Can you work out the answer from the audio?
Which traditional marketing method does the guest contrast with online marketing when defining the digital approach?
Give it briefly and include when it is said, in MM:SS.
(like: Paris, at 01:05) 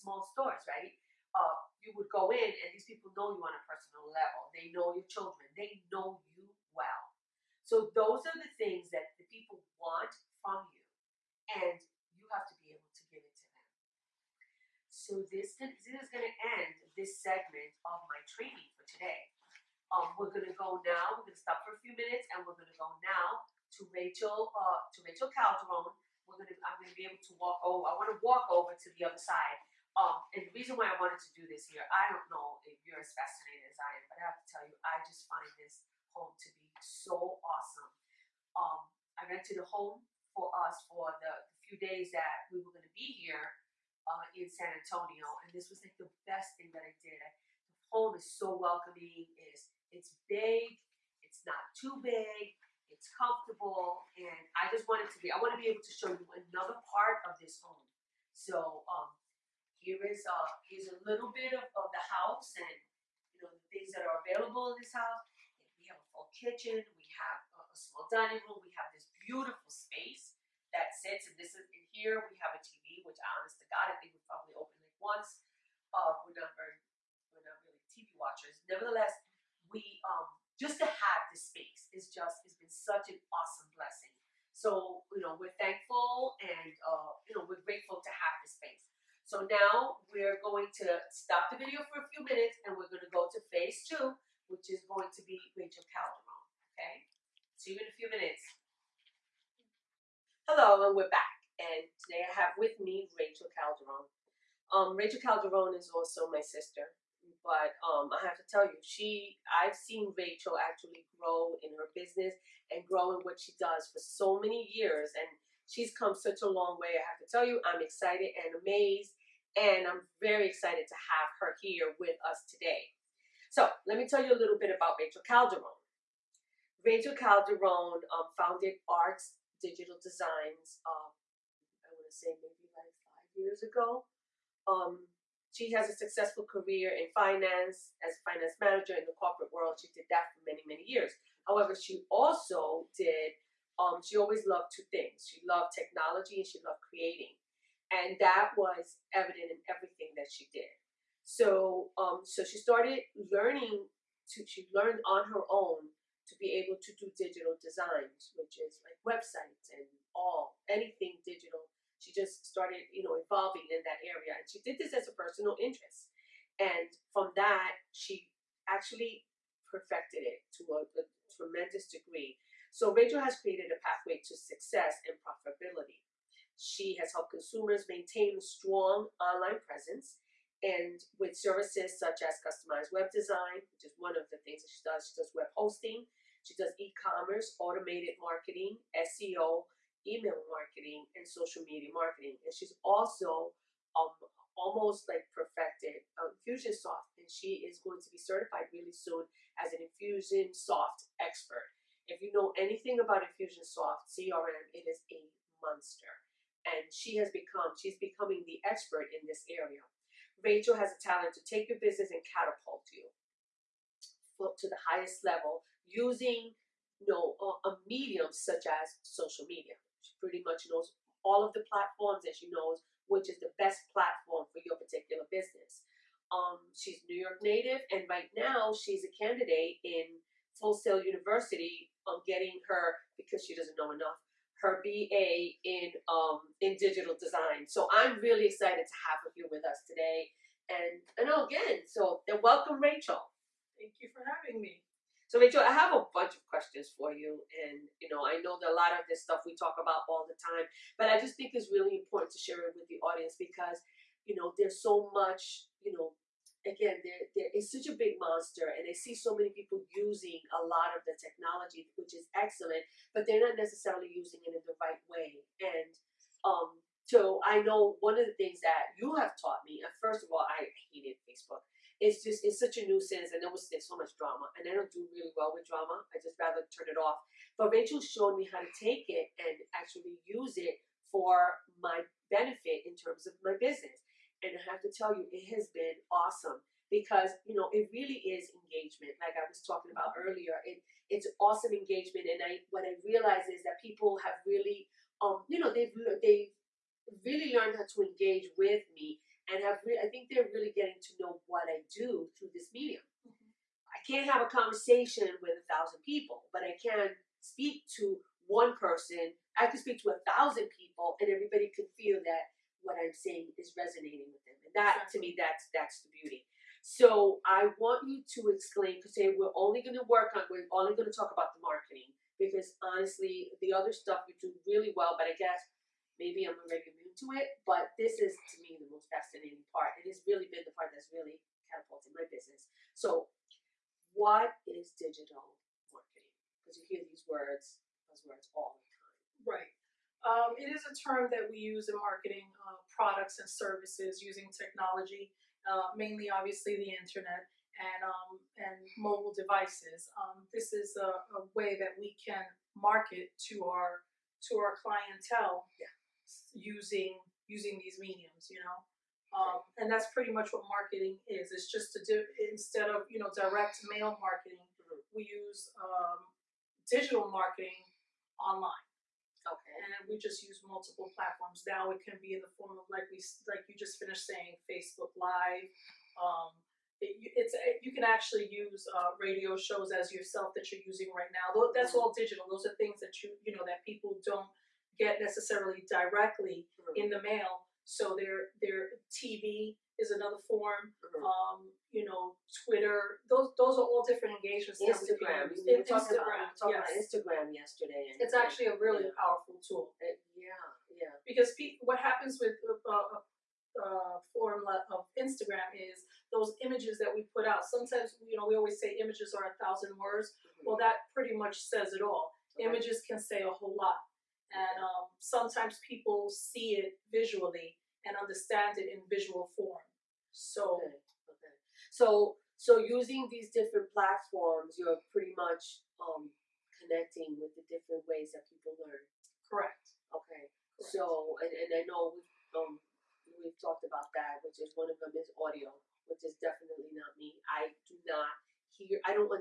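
Direct mail marketing, at 06:03.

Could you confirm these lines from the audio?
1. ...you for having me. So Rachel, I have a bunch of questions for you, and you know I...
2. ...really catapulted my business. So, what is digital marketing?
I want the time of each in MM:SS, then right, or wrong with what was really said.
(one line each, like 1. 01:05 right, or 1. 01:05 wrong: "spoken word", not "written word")
1. 04:04 right
2. 05:31 right.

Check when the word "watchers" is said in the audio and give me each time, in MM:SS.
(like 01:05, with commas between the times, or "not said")
01:18.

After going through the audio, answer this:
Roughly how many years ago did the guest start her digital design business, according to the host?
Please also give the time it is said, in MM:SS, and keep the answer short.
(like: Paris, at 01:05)
5 years, at 02:13.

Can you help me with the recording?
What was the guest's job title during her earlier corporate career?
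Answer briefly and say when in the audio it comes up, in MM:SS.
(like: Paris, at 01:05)
Finance manager, at 02:18.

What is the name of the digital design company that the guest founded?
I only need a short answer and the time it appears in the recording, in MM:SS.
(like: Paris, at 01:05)
AARKS digital designs, at 02:08.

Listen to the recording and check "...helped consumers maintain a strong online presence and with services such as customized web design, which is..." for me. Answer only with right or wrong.
right.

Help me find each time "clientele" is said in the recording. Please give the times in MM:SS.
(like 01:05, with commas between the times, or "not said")
05:54.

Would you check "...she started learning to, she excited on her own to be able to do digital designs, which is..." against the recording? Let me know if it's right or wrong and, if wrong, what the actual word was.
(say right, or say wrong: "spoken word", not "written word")
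wrong: "learned", not "excited".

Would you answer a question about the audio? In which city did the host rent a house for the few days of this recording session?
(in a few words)
San Antonio.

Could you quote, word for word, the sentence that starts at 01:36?
Okay, see you in a few minutes.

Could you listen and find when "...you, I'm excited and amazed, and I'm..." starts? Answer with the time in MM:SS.
01:57.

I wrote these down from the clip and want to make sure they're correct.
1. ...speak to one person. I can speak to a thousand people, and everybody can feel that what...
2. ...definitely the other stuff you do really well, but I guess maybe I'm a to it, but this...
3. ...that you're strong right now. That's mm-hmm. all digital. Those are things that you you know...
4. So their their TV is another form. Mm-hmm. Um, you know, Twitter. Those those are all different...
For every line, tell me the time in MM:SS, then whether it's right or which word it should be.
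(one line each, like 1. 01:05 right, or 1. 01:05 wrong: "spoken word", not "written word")
1. 05:07 right
2. 05:22 wrong: "honestly", not "definitely"
3. 06:20 wrong: "using", not "strong"
4. 06:27 right.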